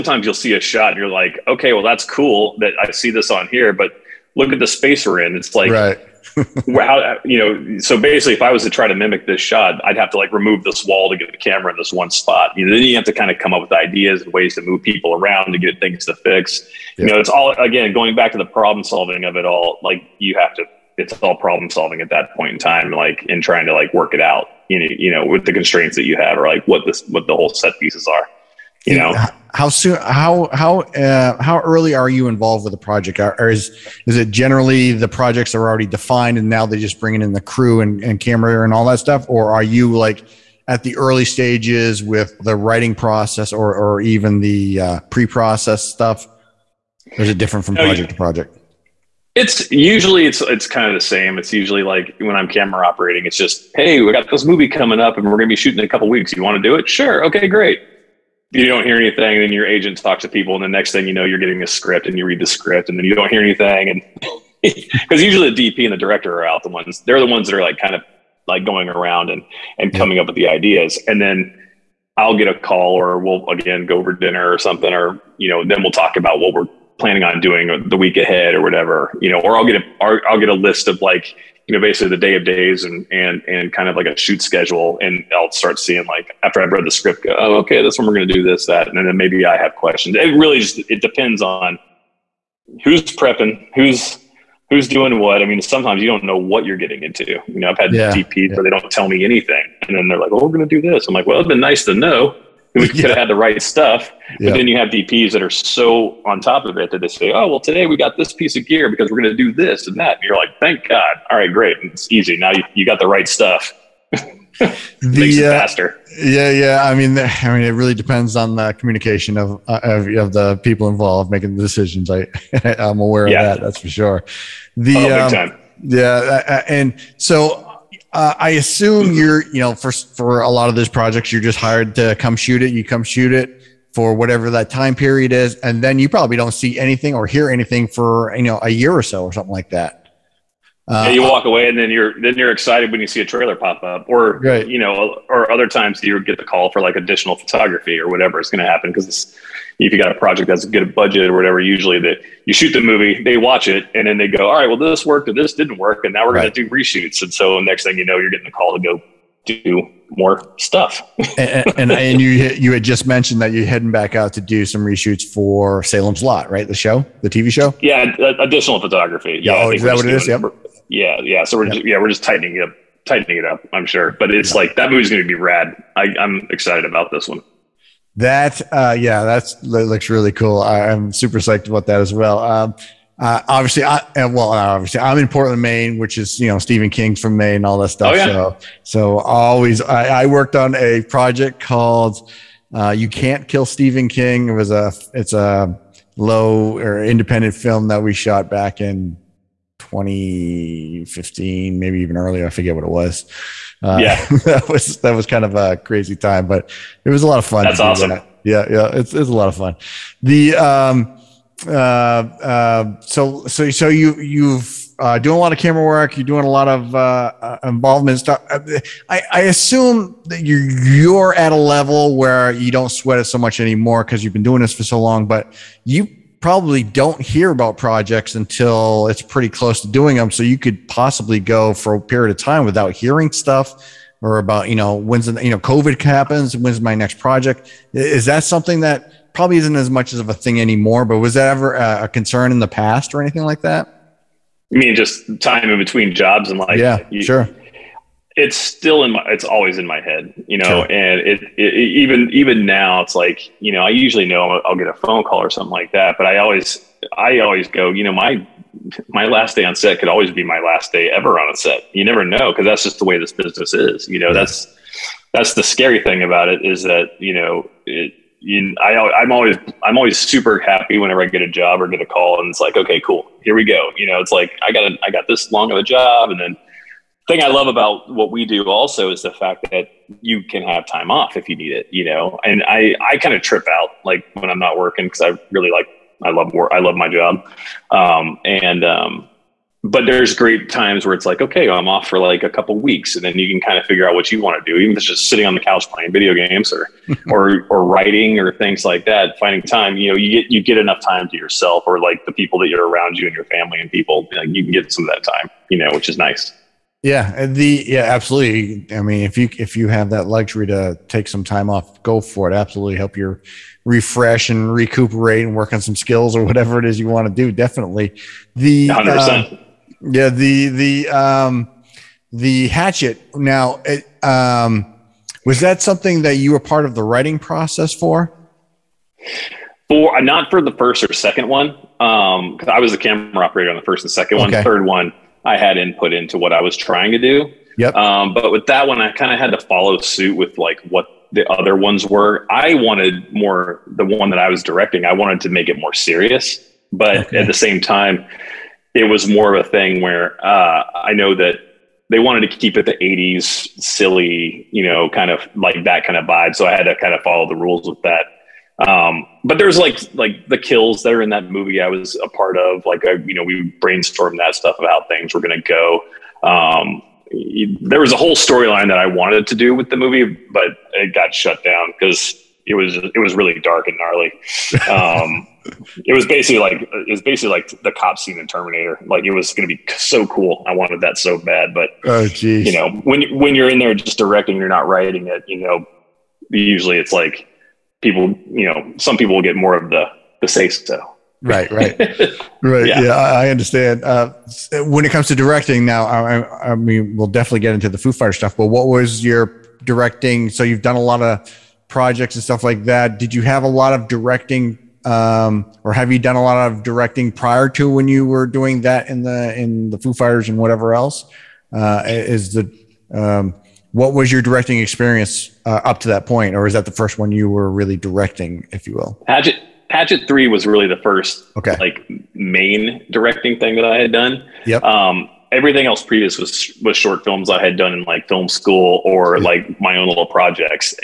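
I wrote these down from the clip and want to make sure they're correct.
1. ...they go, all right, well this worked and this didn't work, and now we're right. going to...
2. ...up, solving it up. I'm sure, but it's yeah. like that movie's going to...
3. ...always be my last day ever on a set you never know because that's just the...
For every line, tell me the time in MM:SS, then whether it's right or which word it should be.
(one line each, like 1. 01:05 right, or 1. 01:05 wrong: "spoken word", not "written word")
1. 02:34 right
2. 02:52 wrong: "tightening", not "solving"
3. 04:20 right.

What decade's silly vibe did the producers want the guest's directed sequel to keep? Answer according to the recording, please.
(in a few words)
the 80s.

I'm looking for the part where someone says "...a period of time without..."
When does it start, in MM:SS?
03:51.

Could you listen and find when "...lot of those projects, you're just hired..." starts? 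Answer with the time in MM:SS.
02:10.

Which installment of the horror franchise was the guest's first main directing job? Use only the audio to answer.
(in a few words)
Hatchet Three.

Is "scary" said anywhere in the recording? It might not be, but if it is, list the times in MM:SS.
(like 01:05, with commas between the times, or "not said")
04:25.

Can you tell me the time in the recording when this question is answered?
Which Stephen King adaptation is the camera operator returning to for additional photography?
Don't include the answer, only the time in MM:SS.
02:45.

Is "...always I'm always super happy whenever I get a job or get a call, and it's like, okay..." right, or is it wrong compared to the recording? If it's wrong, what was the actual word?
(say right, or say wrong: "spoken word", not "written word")
right.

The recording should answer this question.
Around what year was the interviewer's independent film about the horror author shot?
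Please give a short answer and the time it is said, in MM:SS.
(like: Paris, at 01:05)
2015, at 03:19.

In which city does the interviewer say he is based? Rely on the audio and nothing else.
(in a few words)
Portland, Maine.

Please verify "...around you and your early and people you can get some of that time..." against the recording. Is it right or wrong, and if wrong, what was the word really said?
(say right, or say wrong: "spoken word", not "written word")
wrong: "family", not "early".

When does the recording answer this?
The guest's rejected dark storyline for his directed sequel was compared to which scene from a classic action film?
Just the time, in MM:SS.
06:17.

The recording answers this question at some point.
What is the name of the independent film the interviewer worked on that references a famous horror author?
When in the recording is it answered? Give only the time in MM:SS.
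03:12.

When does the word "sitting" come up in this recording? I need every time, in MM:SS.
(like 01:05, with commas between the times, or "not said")
04:55.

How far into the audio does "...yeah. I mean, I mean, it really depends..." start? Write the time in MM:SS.
01:56.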